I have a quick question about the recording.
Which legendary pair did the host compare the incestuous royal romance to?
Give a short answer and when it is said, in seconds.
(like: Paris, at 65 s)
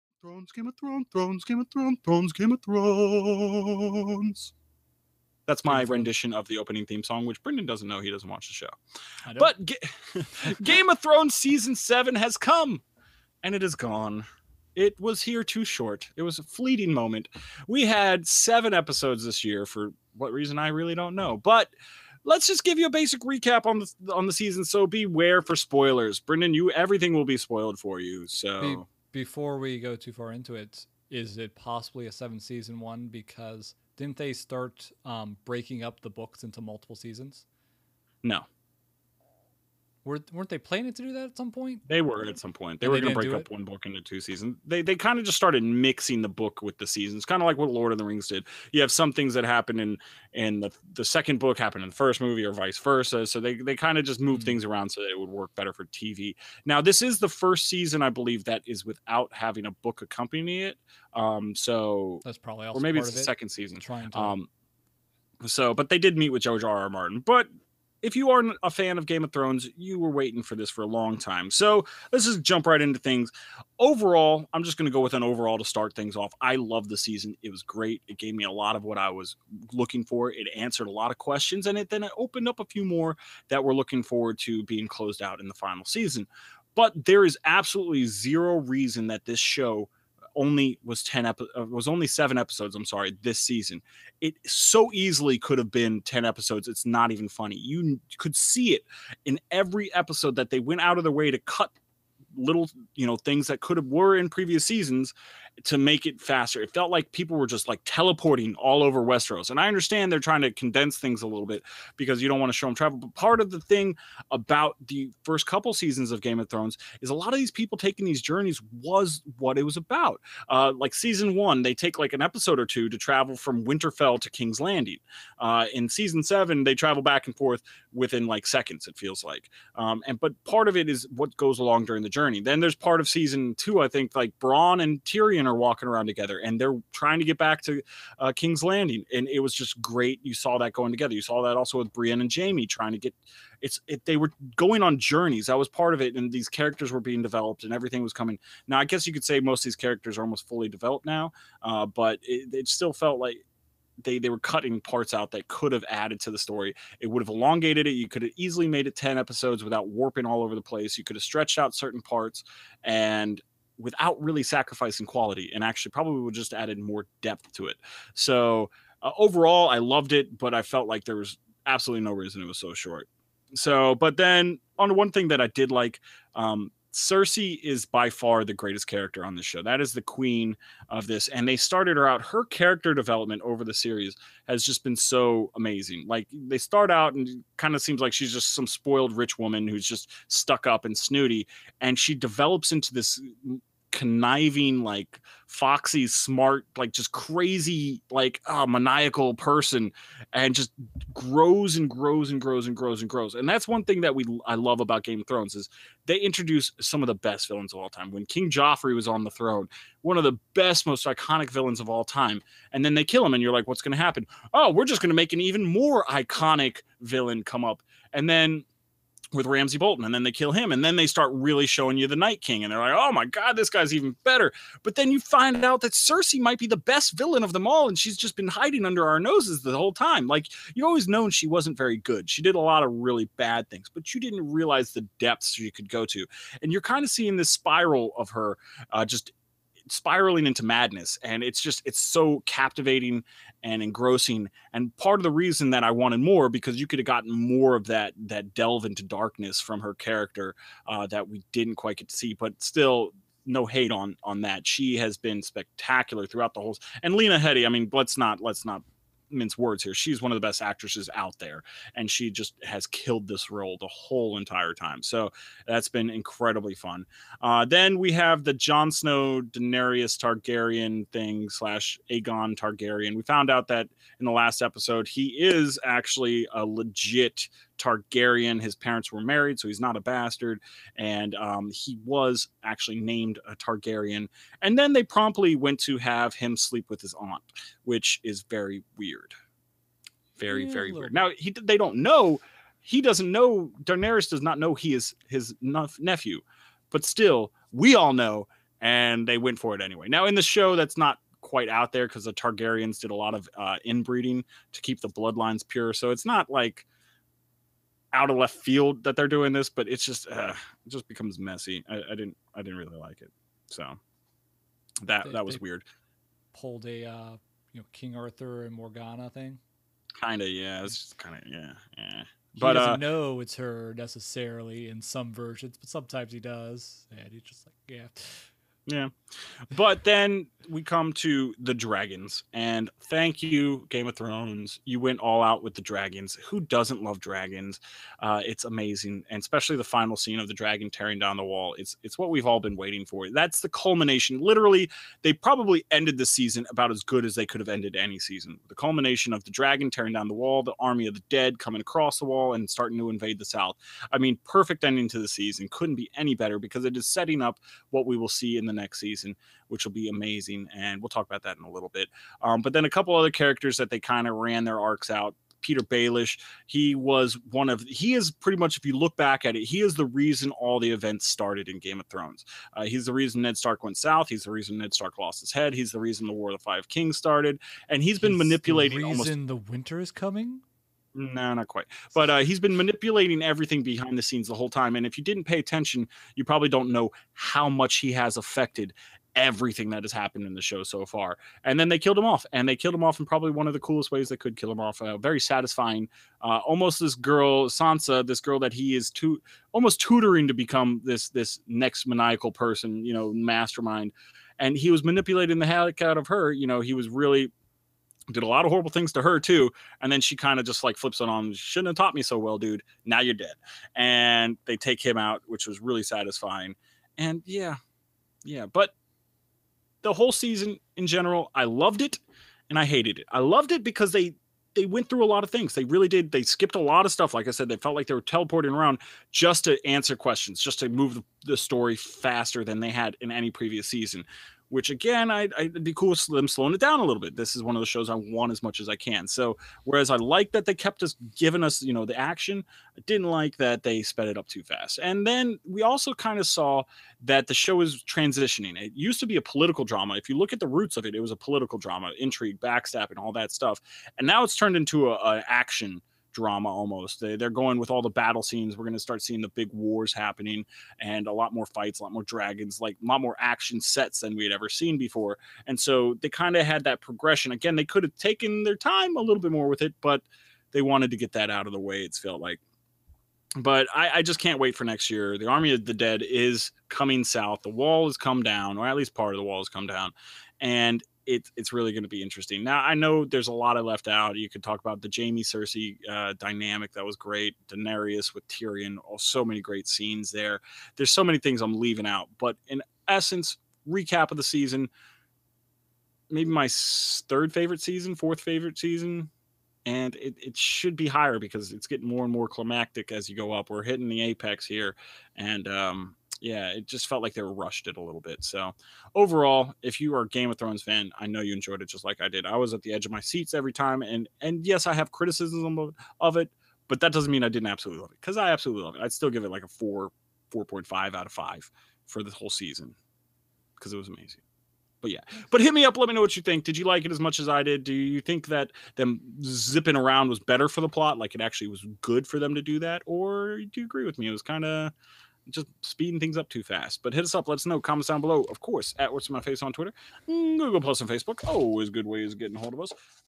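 King Arthur and Morgana, at 317 s.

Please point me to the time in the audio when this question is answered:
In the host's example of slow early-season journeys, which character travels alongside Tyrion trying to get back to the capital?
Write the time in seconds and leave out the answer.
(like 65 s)
134 s.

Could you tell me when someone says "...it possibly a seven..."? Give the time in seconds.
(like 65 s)
31 s.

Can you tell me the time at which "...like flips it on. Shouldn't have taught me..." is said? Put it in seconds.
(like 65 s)
410 s.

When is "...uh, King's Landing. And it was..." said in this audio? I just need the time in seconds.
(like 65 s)
138 s.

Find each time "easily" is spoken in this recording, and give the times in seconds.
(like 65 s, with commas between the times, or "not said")
94 s, 158 s.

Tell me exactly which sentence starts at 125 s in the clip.
Uh, in season seven, they travel back and forth within like seconds, it feels like.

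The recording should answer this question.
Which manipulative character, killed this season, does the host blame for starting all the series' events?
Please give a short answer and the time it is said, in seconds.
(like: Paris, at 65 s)
Petyr Baelish, at 365 s.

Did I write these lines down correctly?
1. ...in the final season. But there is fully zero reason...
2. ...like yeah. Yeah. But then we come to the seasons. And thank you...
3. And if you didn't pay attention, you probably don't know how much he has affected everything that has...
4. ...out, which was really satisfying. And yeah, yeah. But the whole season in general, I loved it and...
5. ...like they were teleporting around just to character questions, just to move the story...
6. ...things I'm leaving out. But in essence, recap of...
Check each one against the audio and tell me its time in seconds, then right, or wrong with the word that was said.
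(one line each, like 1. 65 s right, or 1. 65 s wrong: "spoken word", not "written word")
1. 85 s wrong: "absolutely", not "fully"
2. 327 s wrong: "dragons", not "seasons"
3. 384 s right
4. 415 s right
5. 427 s wrong: "answer", not "character"
6. 491 s right.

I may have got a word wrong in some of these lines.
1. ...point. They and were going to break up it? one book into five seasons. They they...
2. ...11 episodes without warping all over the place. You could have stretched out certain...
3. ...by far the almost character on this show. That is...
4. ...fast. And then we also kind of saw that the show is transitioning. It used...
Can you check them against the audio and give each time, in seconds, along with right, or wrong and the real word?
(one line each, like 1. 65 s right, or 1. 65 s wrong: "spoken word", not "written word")
1. 42 s wrong: "two", not "five"
2. 158 s wrong: "10", not "11"
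3. 177 s wrong: "greatest", not "almost"
4. 444 s right.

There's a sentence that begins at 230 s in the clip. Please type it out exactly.
Like you always known she wasn't very good.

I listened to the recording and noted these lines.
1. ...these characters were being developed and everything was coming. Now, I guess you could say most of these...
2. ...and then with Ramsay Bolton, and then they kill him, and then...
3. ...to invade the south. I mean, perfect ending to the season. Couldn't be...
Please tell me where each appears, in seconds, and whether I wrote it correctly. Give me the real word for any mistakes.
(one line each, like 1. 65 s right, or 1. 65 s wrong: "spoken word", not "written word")
1. 146 s right
2. 218 s right
3. 352 s right.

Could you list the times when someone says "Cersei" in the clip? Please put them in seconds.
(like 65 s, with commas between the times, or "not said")
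176 s, 225 s, 485 s.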